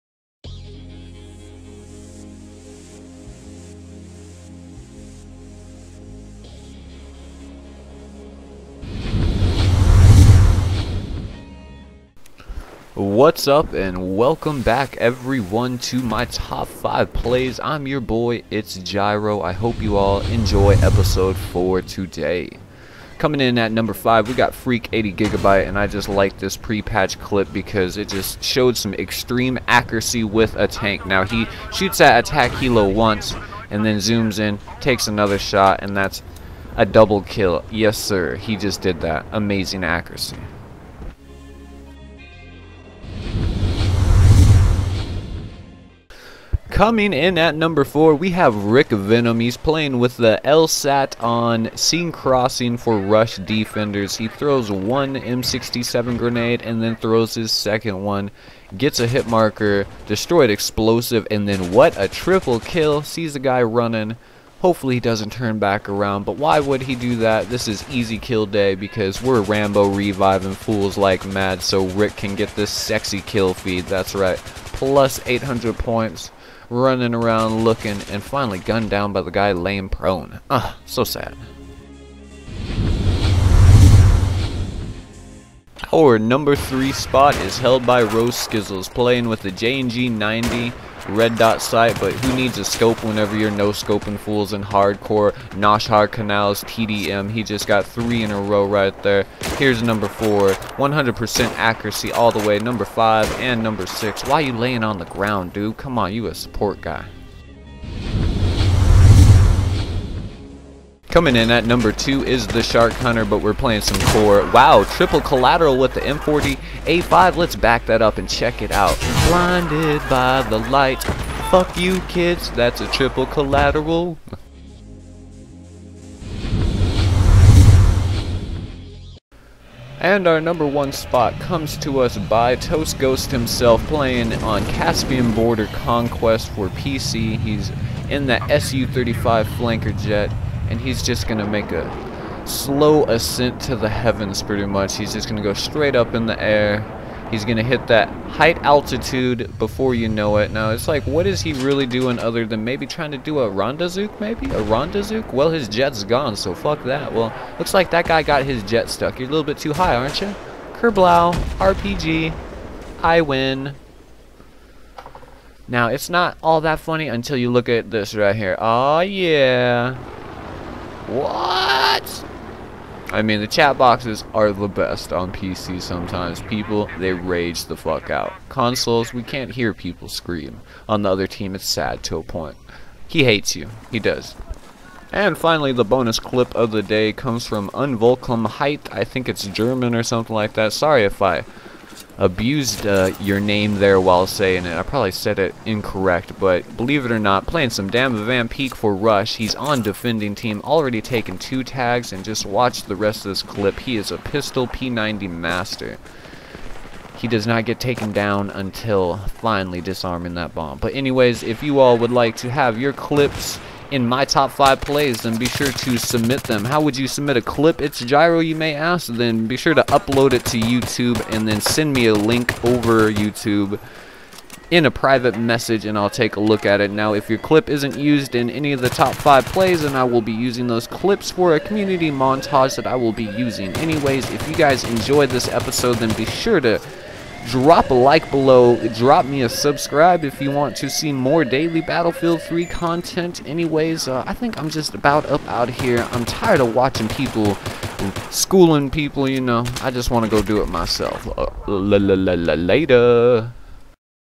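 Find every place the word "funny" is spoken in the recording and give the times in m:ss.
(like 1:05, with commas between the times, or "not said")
2:46.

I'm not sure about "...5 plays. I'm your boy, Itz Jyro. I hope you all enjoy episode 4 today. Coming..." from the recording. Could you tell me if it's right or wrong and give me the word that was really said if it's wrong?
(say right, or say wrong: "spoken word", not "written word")
right.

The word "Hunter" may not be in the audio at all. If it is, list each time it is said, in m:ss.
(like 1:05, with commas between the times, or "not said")
1:52.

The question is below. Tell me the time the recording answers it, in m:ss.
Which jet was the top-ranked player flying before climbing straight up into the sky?
2:18.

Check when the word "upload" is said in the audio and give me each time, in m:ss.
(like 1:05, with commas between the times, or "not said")
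3:39.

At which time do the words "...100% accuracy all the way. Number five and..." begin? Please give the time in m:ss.
1:40.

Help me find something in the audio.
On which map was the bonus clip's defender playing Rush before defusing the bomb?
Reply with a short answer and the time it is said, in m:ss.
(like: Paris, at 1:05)
Damavand Peak, at 3:17.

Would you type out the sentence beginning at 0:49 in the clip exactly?
He's playing with the LSAT on Seine Crossing for rush defenders.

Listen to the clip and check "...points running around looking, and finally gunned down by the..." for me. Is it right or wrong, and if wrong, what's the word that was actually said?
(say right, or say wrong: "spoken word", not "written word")
right.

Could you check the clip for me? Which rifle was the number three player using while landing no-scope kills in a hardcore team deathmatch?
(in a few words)
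JNG 90.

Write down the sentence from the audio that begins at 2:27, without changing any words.
He's going to hit that height altitude before you know it.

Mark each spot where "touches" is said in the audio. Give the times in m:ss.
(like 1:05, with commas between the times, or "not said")
not said.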